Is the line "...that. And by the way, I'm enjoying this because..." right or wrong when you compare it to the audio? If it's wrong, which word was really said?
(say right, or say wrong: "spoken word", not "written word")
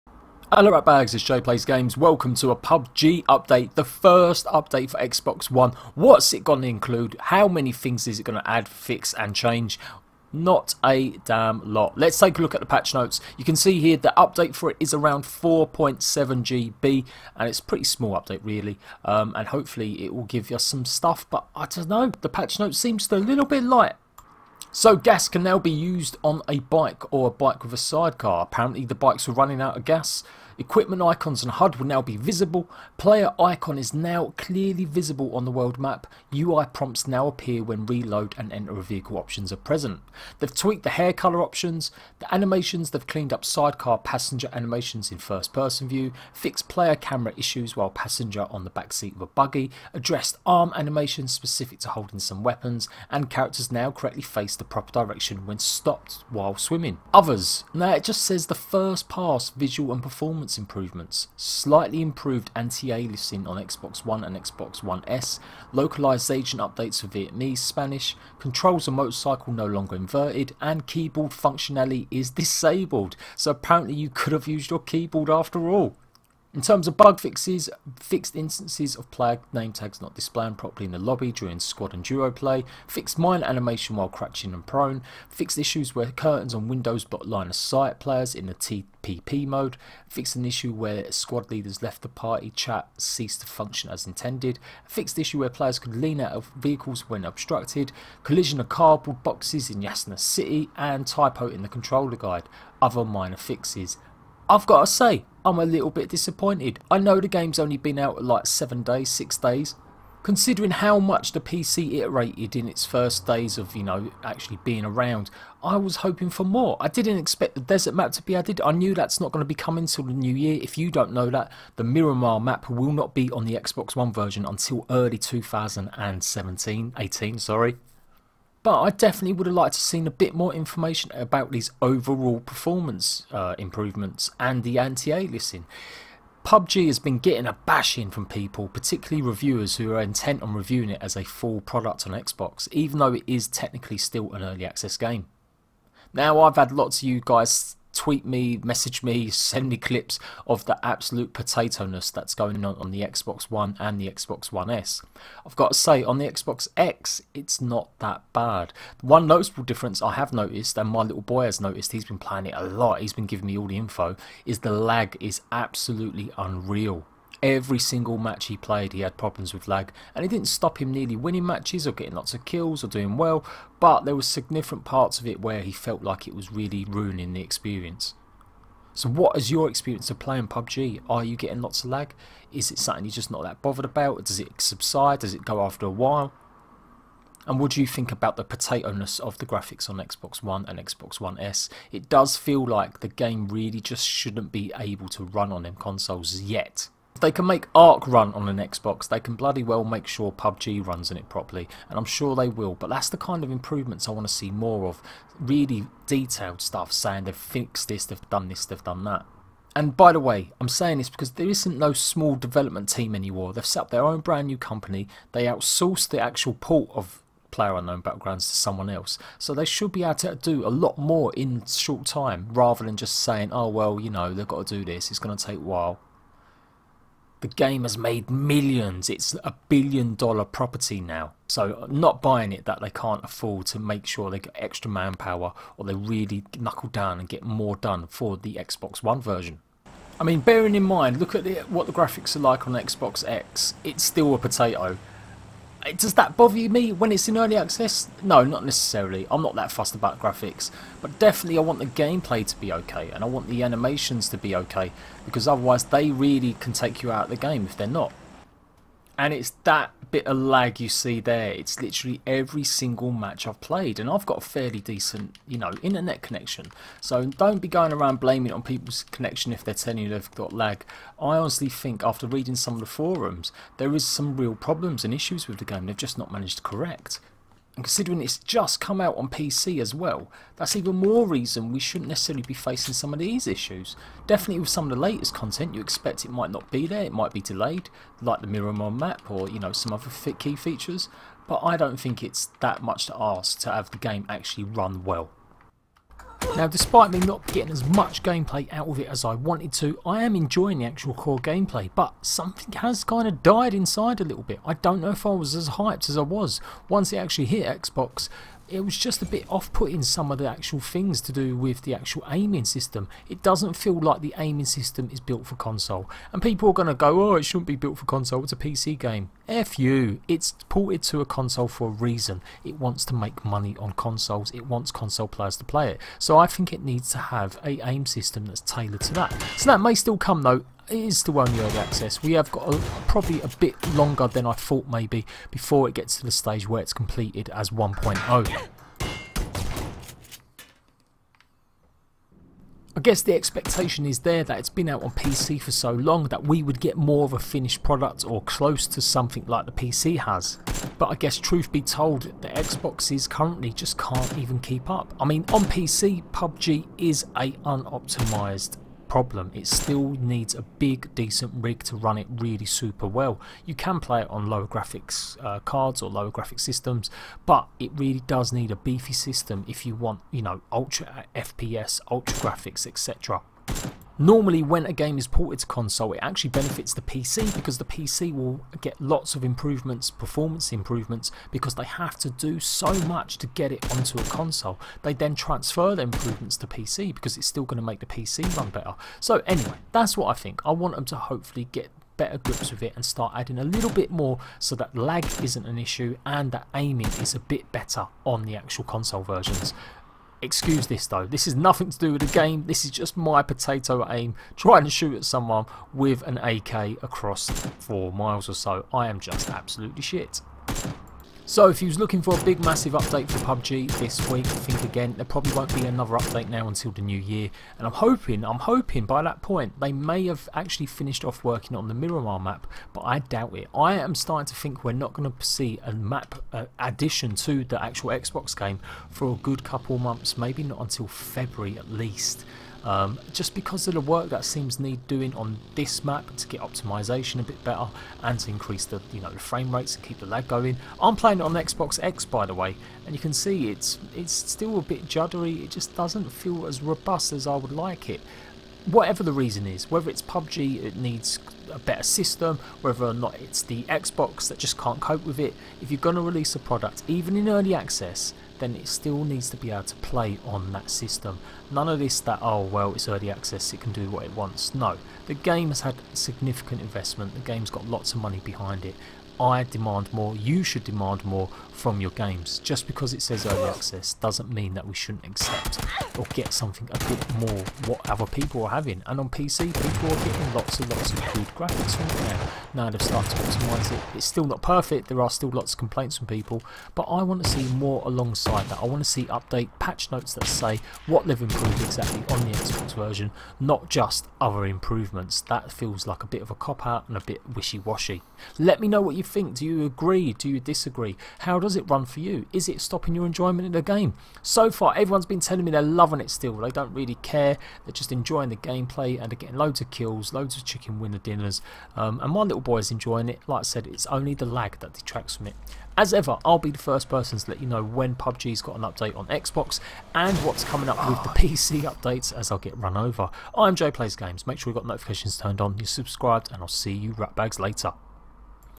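wrong: "saying", not "enjoying".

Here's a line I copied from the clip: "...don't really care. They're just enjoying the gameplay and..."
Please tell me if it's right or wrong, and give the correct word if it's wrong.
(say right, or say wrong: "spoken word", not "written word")
right.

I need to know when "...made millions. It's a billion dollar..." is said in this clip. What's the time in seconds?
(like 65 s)
227 s.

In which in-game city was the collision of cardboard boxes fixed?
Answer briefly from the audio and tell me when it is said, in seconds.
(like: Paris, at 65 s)
Yasna City, at 99 s.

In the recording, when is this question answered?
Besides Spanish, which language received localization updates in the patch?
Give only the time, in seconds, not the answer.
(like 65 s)
67 s.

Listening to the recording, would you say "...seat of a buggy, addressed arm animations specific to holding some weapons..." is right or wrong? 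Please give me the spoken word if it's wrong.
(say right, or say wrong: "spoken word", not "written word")
right.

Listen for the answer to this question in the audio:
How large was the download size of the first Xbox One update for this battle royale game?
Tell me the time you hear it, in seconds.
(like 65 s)
15 s.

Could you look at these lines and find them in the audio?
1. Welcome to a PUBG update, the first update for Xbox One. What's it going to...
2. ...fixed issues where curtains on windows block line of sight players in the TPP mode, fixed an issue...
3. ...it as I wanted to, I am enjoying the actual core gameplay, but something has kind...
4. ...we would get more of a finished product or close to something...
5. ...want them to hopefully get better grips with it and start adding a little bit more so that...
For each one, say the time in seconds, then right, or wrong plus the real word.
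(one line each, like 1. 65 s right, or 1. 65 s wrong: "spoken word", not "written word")
1. 1 s right
2. 85 s right
3. 298 s right
4. 346 s right
5. 390 s right.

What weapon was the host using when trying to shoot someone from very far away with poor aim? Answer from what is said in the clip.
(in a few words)
AK.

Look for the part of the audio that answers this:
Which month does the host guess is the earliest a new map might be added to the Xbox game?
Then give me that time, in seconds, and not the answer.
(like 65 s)
431 s.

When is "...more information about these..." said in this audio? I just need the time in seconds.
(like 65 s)
130 s.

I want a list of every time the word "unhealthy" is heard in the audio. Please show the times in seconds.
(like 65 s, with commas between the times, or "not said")
not said.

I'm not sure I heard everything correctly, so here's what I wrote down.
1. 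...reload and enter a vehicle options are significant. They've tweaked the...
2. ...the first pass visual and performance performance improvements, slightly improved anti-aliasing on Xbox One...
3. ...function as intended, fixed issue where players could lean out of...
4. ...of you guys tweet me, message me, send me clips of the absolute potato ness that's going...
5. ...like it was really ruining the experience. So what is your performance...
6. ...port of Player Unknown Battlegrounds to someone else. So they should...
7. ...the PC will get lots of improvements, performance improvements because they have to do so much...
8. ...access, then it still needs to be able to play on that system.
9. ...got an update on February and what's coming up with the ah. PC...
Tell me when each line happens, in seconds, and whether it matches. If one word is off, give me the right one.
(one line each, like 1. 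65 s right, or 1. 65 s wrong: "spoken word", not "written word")
1. 37 s wrong: "present", not "significant"
2. 58 s right
3. 93 s right
4. 147 s right
5. 176 s wrong: "experience", not "performance"
6. 216 s right
7. 377 s right
8. 457 s right
9. 518 s wrong: "Xbox", not "February".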